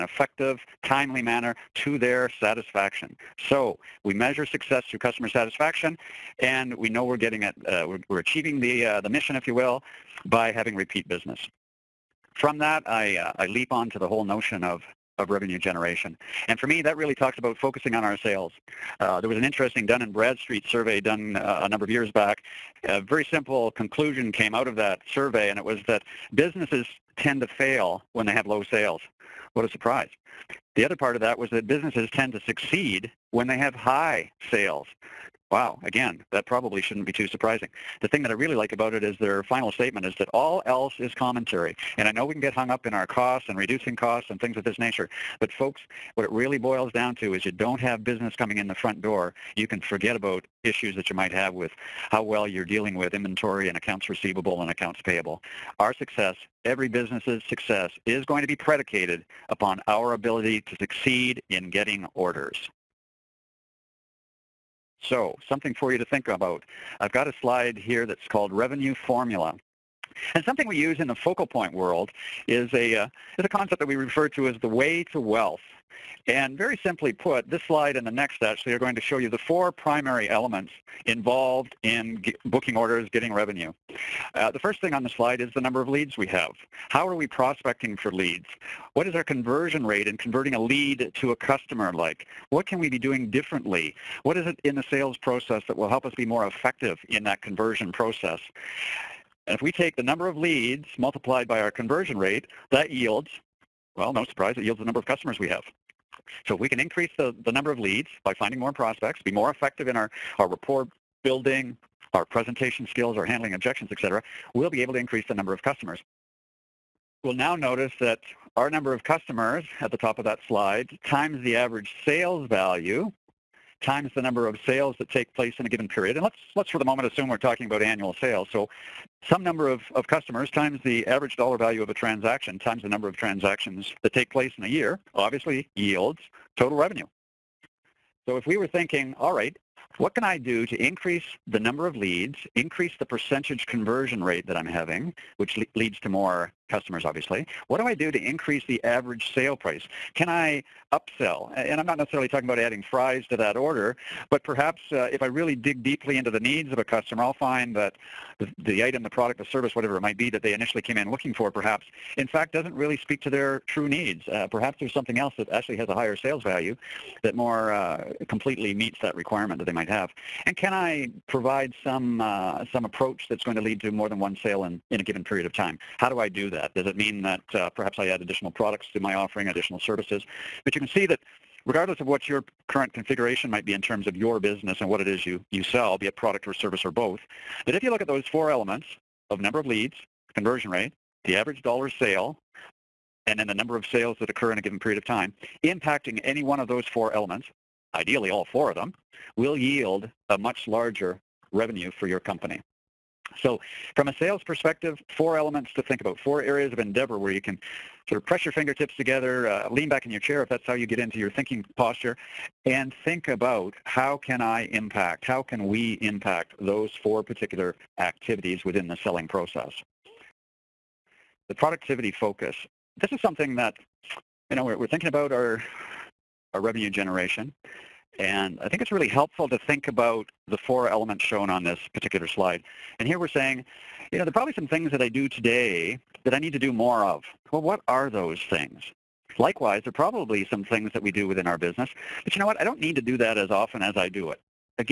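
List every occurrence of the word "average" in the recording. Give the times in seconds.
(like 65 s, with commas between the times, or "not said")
121 s, 131 s, 148 s, 191 s.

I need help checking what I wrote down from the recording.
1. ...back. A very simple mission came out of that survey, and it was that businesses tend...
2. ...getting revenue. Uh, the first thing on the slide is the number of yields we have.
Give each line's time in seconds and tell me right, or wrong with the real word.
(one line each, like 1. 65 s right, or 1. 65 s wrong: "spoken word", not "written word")
1. 22 s wrong: "conclusion", not "mission"
2. 83 s wrong: "leads", not "yields".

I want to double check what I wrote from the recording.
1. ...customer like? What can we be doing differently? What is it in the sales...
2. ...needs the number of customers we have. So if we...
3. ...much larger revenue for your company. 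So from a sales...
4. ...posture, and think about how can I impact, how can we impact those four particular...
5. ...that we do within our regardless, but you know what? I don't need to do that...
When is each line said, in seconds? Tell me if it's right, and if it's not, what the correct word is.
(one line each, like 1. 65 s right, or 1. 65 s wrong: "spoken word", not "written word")
1. 91 s right
2. 104 s wrong: "yields", not "needs"
3. 200 s right
4. 211 s right
5. 240 s wrong: "business", not "regardless".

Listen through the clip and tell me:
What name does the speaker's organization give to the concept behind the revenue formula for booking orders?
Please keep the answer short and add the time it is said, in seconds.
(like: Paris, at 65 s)
the way to wealth, at 74 s.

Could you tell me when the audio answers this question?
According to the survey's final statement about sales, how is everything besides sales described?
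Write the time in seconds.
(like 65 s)
41 s.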